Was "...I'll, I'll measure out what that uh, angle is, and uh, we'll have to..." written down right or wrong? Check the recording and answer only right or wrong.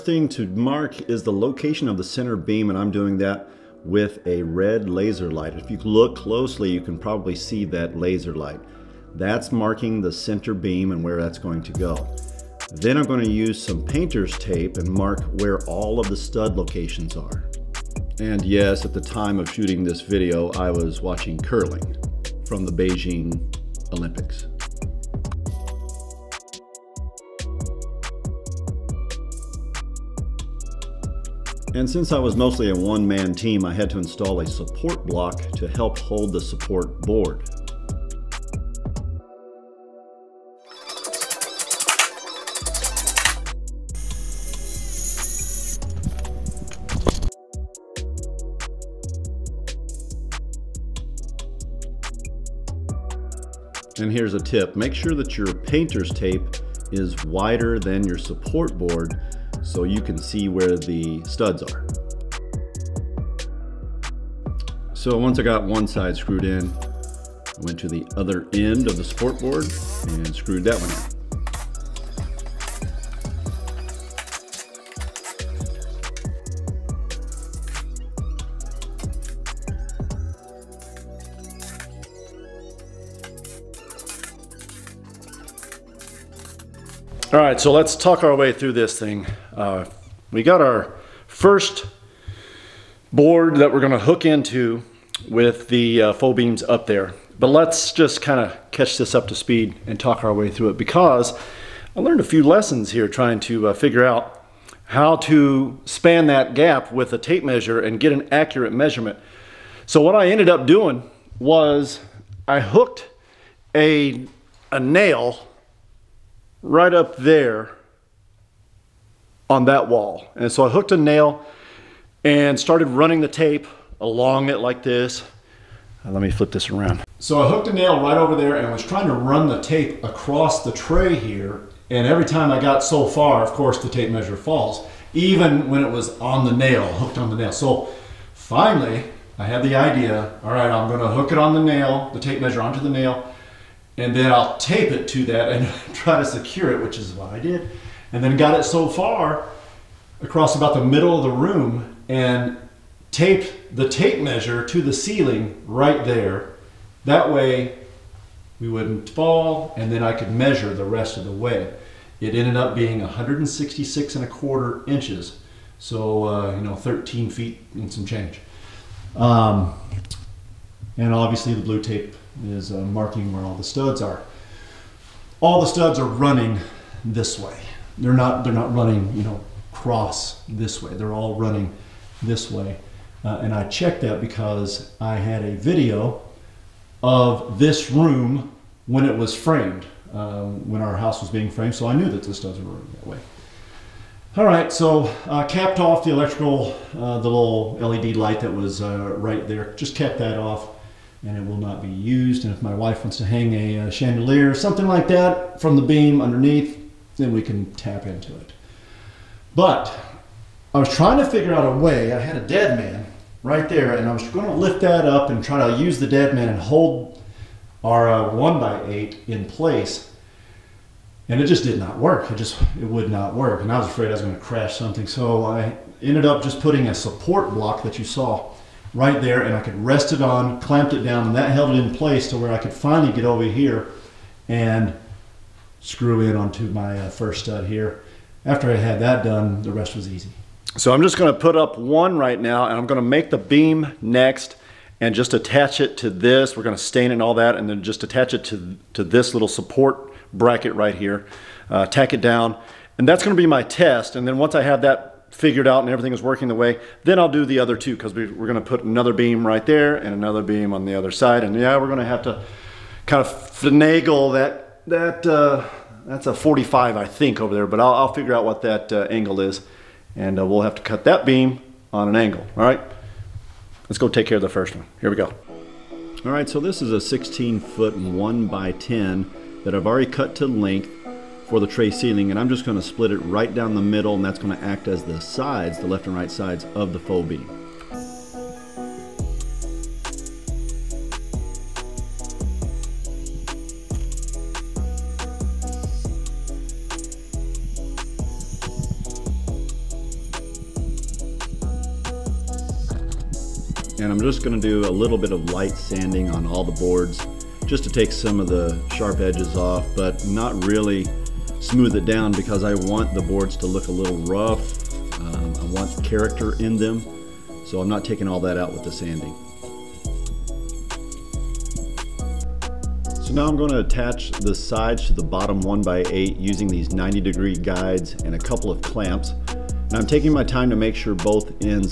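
wrong.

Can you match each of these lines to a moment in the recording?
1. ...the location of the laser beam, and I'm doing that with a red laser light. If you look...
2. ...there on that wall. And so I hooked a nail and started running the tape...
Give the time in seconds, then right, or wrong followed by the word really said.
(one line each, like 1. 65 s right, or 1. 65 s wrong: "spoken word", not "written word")
1. 1 s wrong: "center", not "laser"
2. 117 s right.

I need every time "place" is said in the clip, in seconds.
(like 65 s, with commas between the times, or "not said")
219 s, 231 s.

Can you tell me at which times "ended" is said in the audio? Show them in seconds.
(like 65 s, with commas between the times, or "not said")
110 s, 162 s, 226 s.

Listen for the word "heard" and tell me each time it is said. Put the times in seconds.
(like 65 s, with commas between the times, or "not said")
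not said.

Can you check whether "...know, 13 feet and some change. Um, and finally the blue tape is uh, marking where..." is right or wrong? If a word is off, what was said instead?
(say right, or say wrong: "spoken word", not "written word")
wrong: "obviously", not "finally".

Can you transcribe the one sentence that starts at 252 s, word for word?
And that's gonna be my test.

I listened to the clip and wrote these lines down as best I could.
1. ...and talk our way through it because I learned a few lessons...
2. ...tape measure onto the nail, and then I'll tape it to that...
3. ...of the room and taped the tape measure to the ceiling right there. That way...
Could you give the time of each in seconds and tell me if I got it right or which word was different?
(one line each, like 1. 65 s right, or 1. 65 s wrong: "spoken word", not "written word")
1. 99 s right
2. 142 s right
3. 151 s right.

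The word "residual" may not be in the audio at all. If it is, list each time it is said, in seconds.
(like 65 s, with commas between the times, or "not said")
not said.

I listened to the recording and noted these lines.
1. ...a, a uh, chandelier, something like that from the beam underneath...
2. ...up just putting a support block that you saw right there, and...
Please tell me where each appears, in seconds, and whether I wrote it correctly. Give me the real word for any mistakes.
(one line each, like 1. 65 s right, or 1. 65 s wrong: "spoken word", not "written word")
1. 203 s right
2. 226 s right.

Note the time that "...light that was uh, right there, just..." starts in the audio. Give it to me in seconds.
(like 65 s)
198 s.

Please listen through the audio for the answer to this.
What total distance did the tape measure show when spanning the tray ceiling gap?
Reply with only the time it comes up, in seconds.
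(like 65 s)
163 s.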